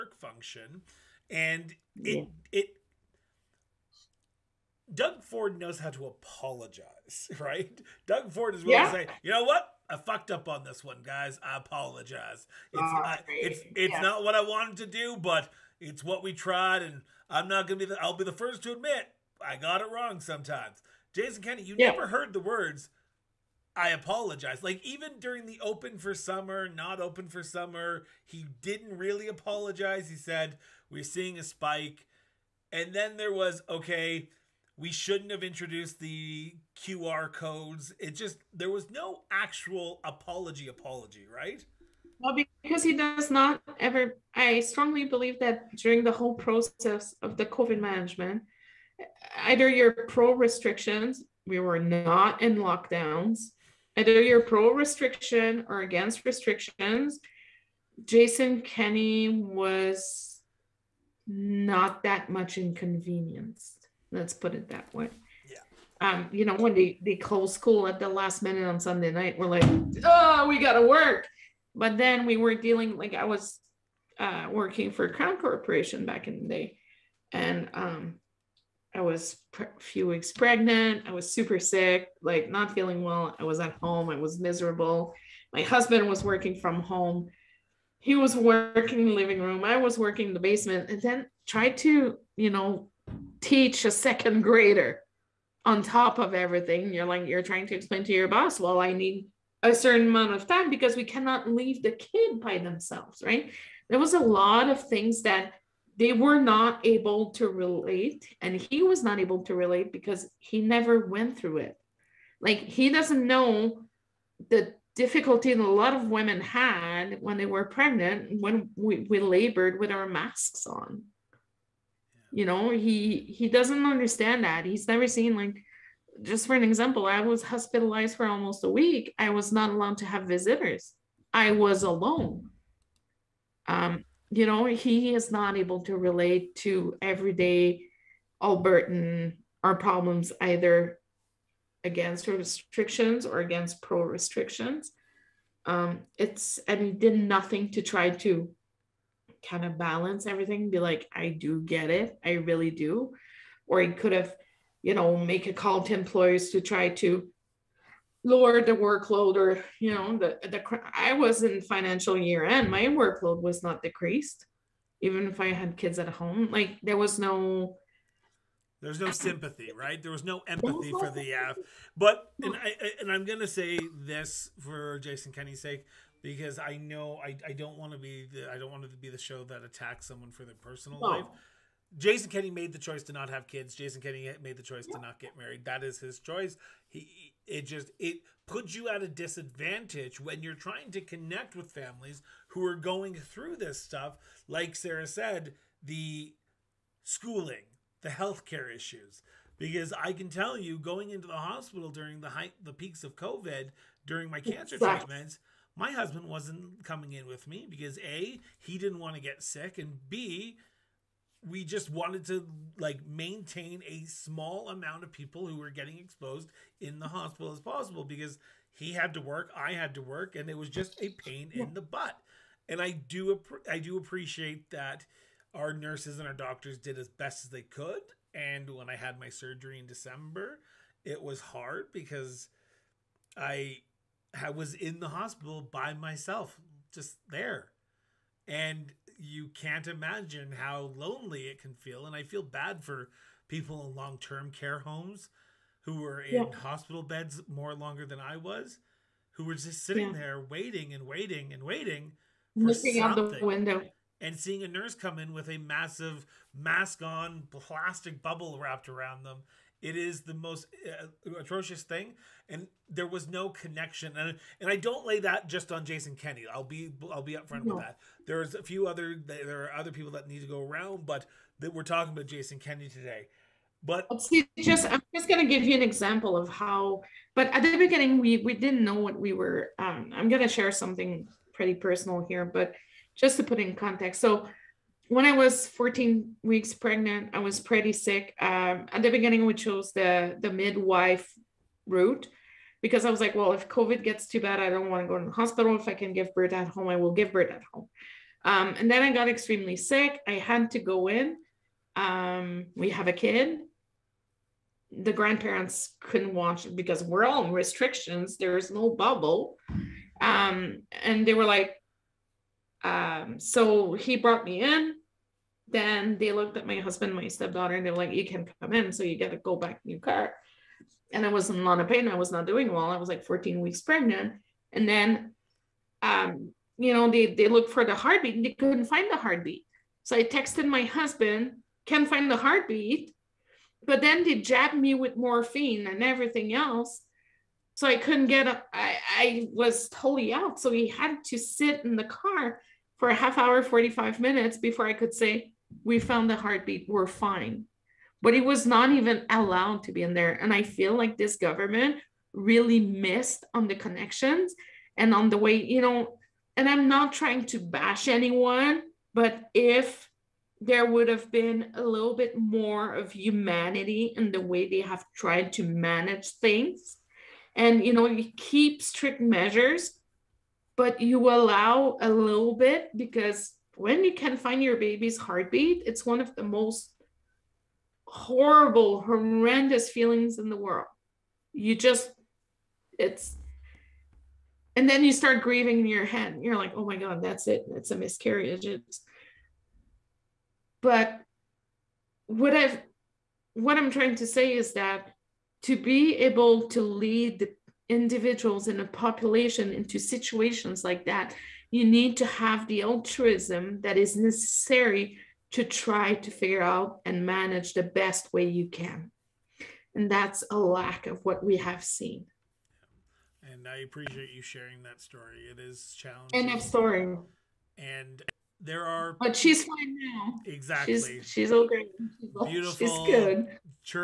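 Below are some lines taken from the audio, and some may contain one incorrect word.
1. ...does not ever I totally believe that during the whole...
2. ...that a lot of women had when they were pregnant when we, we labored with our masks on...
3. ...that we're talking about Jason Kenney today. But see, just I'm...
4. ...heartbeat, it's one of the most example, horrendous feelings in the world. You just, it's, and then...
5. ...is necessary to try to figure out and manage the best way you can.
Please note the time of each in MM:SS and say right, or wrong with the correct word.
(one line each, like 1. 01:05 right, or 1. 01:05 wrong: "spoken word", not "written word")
1. 00:42 wrong: "strongly", not "totally"
2. 01:55 right
3. 04:31 right
4. 06:15 wrong: "horrible", not "example"
5. 06:43 right.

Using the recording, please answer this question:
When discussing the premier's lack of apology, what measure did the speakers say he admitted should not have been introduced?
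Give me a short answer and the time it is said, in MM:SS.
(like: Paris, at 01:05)
QR codes, at 00:36.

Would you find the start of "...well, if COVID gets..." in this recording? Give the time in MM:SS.
04:53.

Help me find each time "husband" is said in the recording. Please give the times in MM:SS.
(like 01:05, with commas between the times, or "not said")
01:25, 03:25, 05:16, 05:30.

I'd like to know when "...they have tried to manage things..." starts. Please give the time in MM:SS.
06:04.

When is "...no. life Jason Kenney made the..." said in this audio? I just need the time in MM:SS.
03:01.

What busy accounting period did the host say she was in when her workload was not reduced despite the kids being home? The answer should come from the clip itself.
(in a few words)
Financial year end.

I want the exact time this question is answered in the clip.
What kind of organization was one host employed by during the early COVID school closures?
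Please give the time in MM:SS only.
01:15.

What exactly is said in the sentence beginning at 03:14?
Like Sarah said, the schooling, the healthcare issues.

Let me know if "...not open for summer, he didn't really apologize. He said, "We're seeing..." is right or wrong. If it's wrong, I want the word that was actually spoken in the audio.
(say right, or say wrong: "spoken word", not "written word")
right.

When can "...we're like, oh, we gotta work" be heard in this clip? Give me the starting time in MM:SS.
01:09.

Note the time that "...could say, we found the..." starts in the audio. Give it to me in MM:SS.
05:44.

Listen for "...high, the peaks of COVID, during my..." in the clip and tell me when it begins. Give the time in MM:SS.
03:22.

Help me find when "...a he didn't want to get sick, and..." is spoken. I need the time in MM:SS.
03:27.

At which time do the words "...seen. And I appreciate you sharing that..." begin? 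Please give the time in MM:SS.
06:51.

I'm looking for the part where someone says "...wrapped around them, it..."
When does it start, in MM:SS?
04:18.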